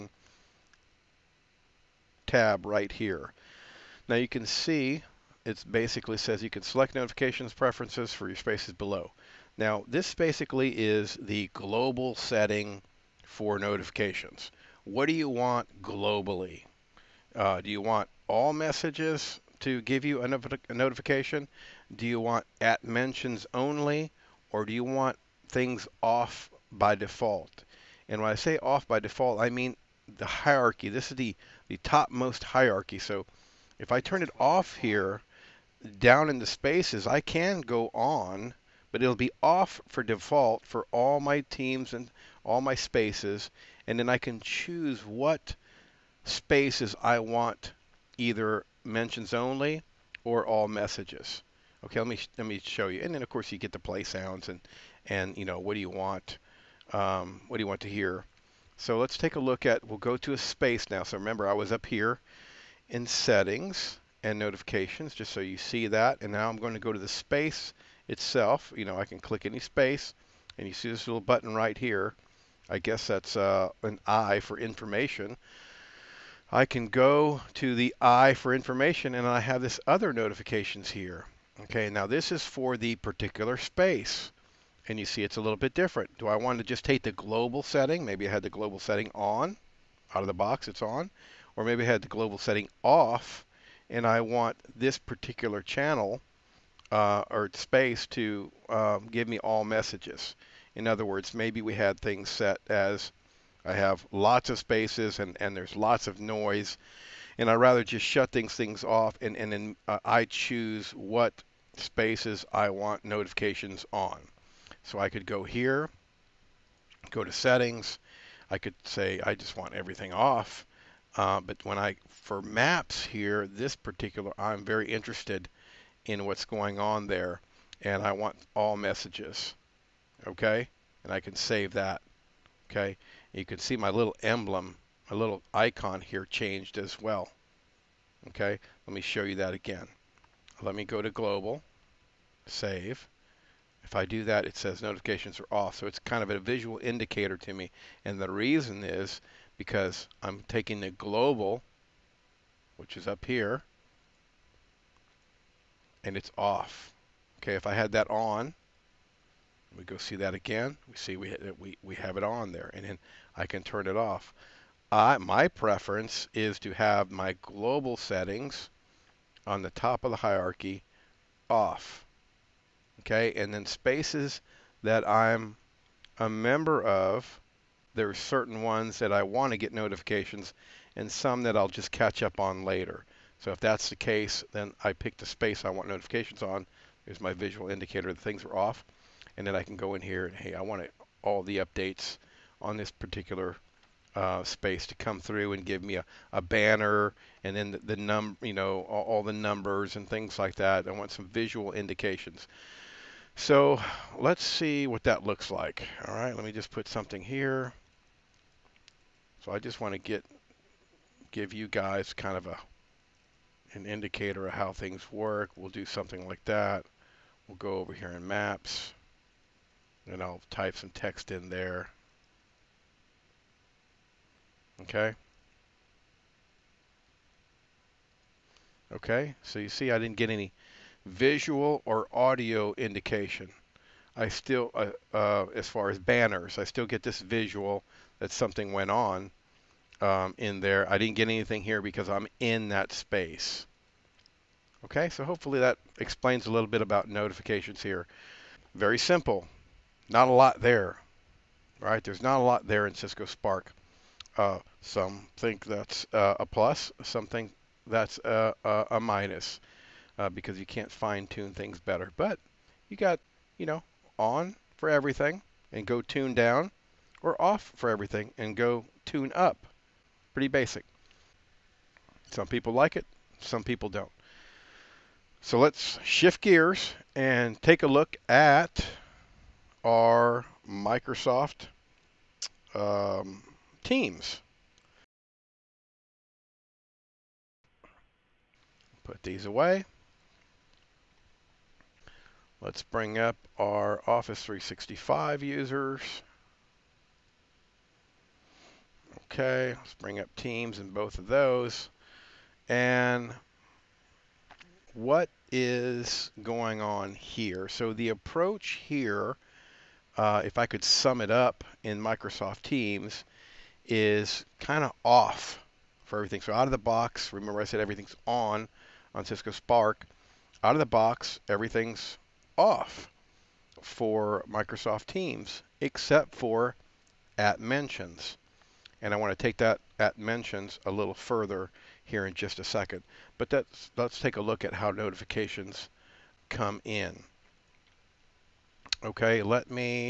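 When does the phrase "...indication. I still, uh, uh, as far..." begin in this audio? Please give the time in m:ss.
3:52.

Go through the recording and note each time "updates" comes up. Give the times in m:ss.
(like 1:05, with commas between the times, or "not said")
3:11.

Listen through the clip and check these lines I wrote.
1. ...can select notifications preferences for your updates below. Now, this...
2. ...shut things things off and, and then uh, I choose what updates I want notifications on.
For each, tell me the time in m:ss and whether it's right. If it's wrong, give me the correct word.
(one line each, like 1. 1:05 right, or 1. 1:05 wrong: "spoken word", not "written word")
1. 0:06 wrong: "spaces", not "updates"
2. 1:48 wrong: "spaces", not "updates".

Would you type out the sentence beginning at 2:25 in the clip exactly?
So it's kind of a visual indicator to me.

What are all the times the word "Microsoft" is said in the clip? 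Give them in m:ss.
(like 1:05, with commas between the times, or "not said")
4:40, 5:12, 5:24.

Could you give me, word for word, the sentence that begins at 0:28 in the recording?
And when I say off by default, I mean the hierarchy.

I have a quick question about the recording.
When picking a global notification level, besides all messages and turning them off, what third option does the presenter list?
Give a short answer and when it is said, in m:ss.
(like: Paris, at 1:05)
At mentions only, at 0:22.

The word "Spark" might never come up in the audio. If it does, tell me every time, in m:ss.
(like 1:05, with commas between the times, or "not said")
4:13, 5:19.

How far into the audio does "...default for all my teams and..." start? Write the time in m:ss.
0:40.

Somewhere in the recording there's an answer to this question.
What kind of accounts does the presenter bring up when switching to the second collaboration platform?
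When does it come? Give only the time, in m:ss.
4:54.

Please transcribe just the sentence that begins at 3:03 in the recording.
So if that's the case, then I pick the space I want notifications on.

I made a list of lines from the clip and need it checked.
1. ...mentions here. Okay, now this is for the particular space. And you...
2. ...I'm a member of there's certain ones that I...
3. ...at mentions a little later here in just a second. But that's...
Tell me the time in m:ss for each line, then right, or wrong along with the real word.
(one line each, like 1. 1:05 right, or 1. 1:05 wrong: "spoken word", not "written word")
1. 1:20 wrong: "notifications", not "mentions"
2. 2:55 right
3. 5:29 wrong: "further", not "later".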